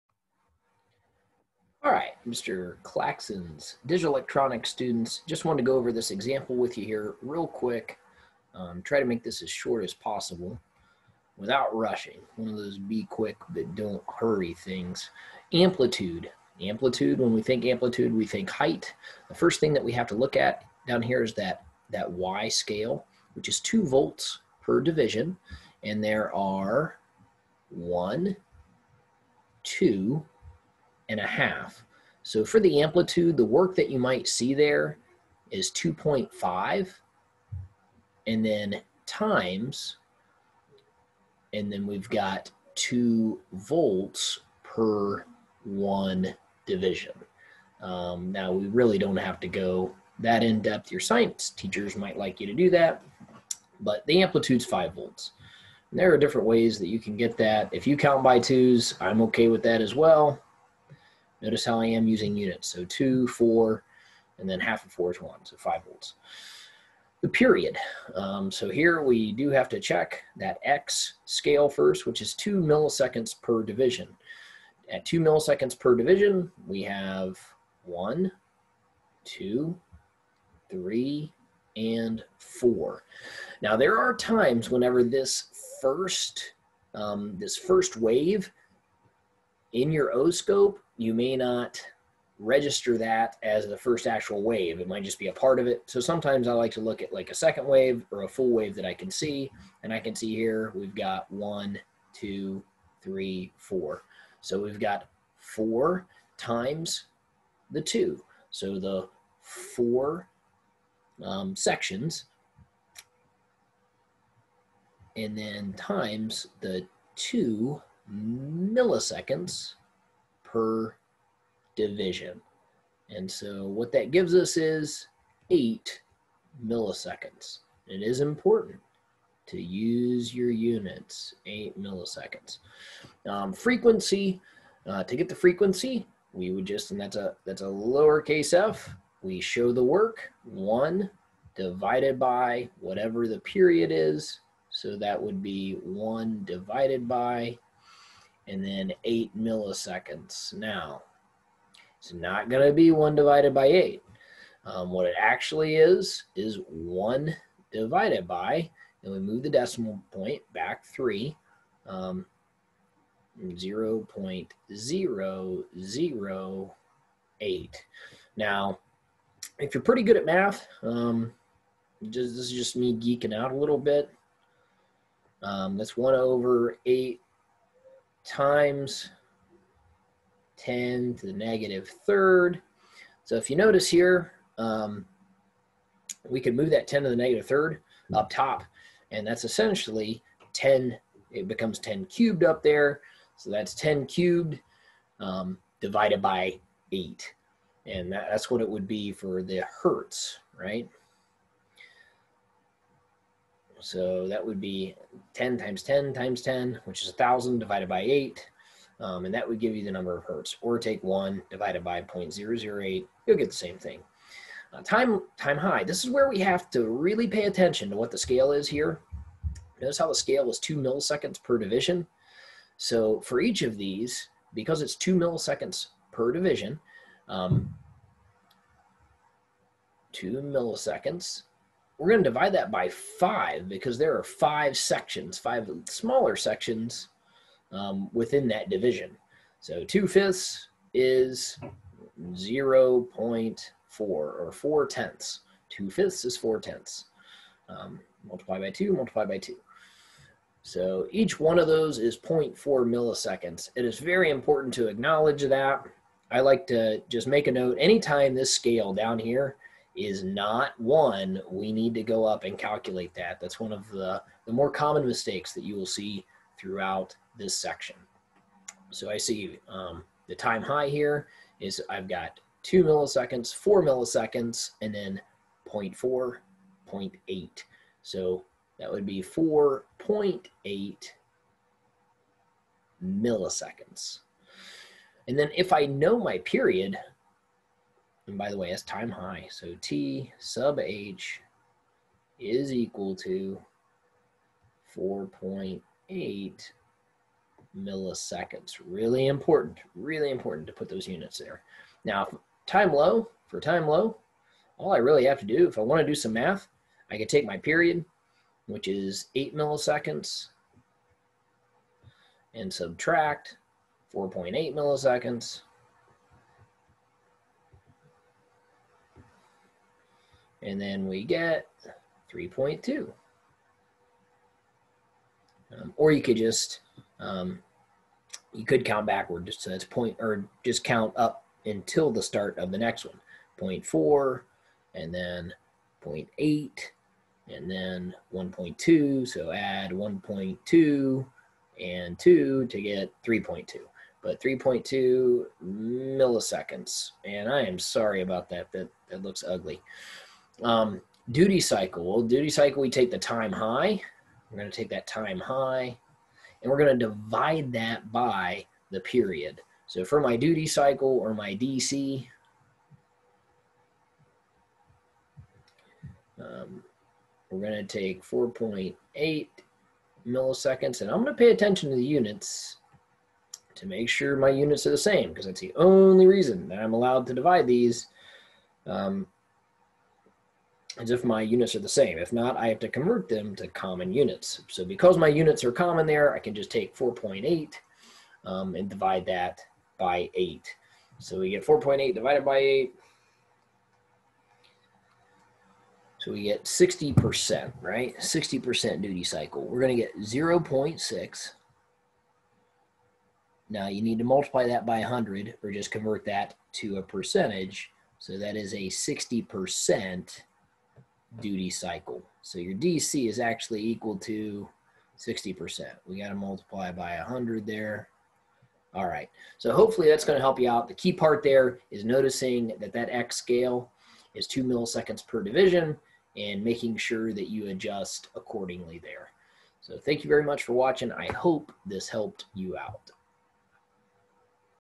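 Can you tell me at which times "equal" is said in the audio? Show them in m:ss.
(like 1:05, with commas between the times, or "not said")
4:52, 6:53.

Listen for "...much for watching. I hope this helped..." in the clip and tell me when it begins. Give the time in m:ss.
7:10.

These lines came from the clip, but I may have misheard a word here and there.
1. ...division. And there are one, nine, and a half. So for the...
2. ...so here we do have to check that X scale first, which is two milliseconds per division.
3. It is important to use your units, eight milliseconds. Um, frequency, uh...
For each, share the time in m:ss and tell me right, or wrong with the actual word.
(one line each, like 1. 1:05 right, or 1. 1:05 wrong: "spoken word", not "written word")
1. 0:24 wrong: "two", not "nine"
2. 1:08 right
3. 2:07 right.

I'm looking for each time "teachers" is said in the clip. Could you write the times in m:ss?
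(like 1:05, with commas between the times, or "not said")
0:51.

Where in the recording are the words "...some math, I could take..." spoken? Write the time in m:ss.
5:06.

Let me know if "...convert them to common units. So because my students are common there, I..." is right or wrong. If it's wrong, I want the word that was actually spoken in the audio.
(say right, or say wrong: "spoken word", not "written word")
wrong: "units", not "students".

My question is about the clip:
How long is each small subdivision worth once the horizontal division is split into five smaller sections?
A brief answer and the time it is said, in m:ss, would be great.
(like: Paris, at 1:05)
0.4 milliseconds, at 4:12.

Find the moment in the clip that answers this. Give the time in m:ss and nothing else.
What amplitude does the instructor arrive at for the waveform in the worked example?
0:54.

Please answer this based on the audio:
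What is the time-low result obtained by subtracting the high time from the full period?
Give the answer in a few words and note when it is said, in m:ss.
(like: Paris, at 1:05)
3.2 milliseconds, at 5:44.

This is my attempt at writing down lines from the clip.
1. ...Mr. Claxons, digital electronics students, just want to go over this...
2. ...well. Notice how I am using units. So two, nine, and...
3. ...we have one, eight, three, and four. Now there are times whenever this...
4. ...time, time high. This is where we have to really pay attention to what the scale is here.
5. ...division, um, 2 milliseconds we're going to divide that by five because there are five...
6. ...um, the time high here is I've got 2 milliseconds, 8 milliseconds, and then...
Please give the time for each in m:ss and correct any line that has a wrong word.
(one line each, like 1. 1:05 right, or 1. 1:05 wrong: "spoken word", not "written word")
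1. 0:02 right
2. 0:59 wrong: "four", not "nine"
3. 1:16 wrong: "two", not "eight"
4. 3:34 right
5. 3:46 right
6. 4:29 wrong: "4", not "8".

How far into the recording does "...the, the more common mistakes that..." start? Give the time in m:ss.
4:23.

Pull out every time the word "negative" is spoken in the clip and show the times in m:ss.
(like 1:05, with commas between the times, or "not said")
3:01, 3:07.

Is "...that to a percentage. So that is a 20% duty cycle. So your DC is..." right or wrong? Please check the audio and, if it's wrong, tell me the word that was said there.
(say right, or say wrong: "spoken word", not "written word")
wrong: "60", not "20".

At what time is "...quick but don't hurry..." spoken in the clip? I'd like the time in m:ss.
0:13.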